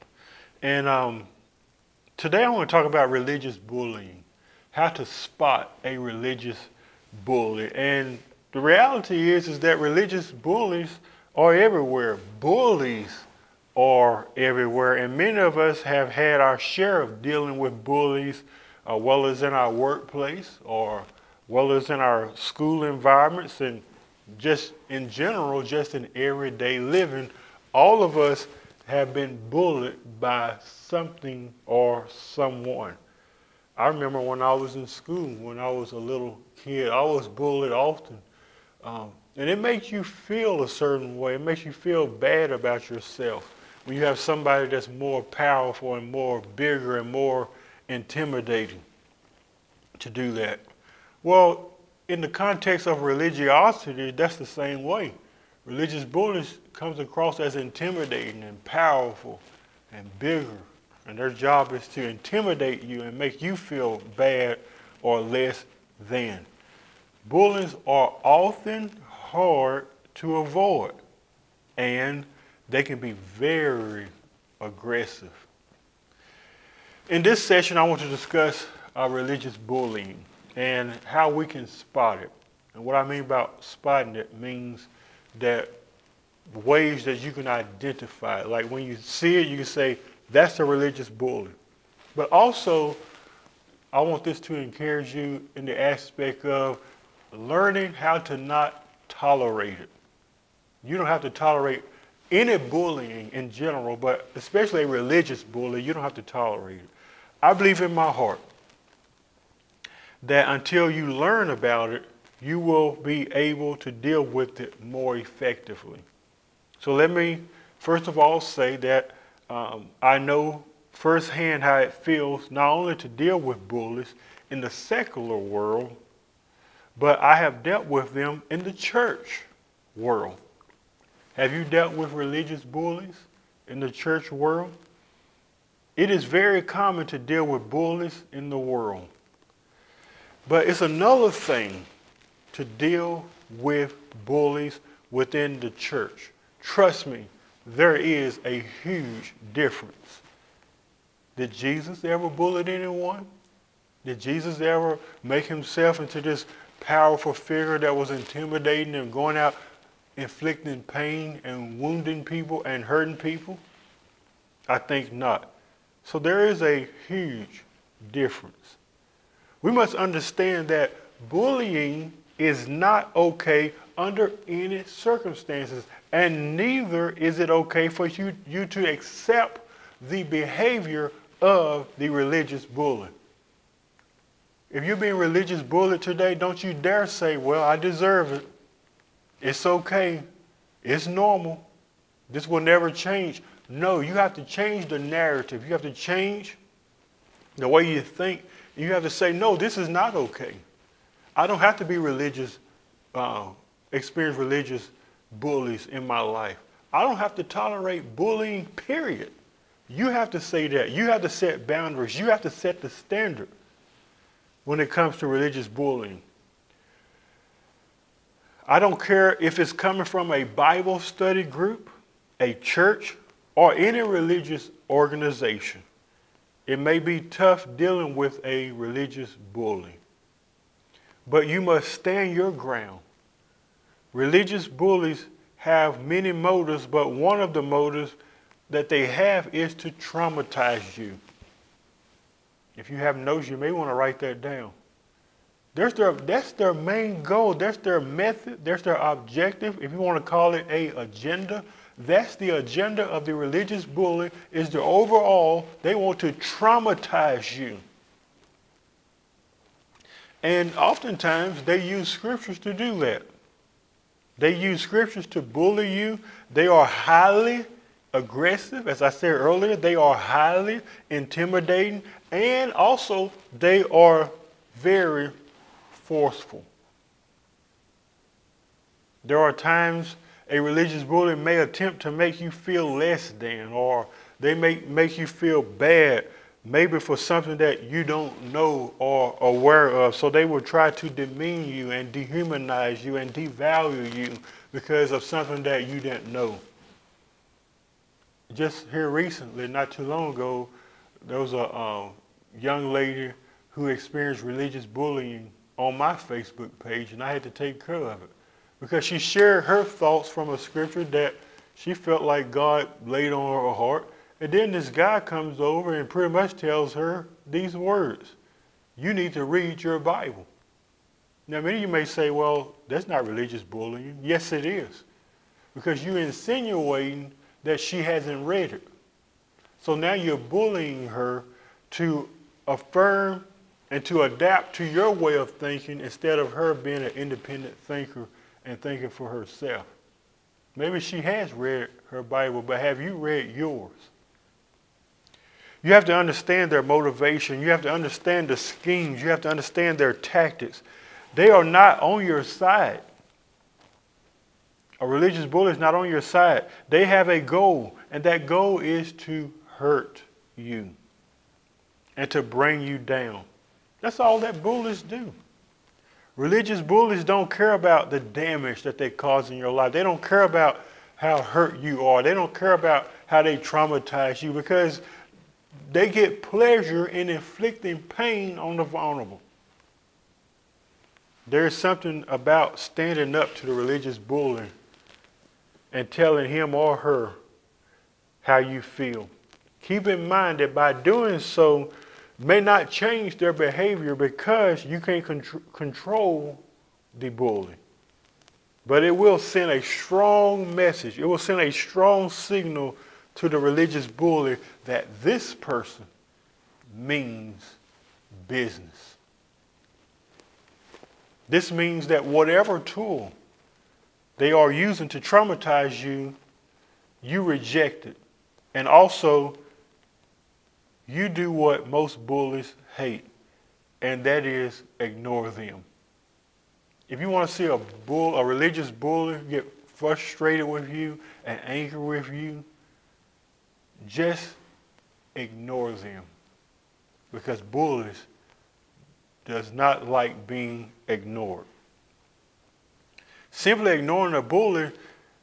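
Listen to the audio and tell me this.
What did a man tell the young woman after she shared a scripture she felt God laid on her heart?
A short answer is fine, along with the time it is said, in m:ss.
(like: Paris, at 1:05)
You need to read your Bible, at 5:19.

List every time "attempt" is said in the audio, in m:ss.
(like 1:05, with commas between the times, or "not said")
4:41.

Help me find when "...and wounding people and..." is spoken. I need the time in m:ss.
2:41.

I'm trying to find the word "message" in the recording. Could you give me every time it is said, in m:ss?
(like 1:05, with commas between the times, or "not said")
6:40.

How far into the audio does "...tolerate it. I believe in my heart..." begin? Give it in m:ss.
1:46.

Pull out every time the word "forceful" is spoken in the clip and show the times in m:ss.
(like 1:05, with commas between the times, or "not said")
4:36.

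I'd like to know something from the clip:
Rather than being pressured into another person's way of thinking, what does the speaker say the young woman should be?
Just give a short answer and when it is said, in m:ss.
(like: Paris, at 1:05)
An independent thinker, at 5:37.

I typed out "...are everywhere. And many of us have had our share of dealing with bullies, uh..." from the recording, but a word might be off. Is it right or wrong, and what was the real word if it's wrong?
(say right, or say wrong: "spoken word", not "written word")
right.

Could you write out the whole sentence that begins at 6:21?
There's something about standing up to the religious bully and telling him or her how you feel.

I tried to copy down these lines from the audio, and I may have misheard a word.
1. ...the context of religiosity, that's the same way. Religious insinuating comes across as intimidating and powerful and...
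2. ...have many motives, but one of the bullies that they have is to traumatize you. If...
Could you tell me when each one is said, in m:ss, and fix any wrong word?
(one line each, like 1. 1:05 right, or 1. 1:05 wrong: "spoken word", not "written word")
1. 0:52 wrong: "bullying", not "insinuating"
2. 3:55 wrong: "motives", not "bullies".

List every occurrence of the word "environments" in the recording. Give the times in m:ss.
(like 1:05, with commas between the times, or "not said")
0:22.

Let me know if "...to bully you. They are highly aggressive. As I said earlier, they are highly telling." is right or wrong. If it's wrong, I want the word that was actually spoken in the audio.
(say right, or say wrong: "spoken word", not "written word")
wrong: "intimidating", not "telling".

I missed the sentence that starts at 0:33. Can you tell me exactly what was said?
I remember when I was in school, when I was a little kid, I was bullied often.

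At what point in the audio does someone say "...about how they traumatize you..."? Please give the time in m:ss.
6:12.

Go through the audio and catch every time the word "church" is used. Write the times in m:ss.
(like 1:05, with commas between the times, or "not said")
2:08, 2:13, 2:25, 3:42.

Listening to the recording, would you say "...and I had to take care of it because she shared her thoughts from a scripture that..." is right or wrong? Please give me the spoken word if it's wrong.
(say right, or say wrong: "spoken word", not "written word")
right.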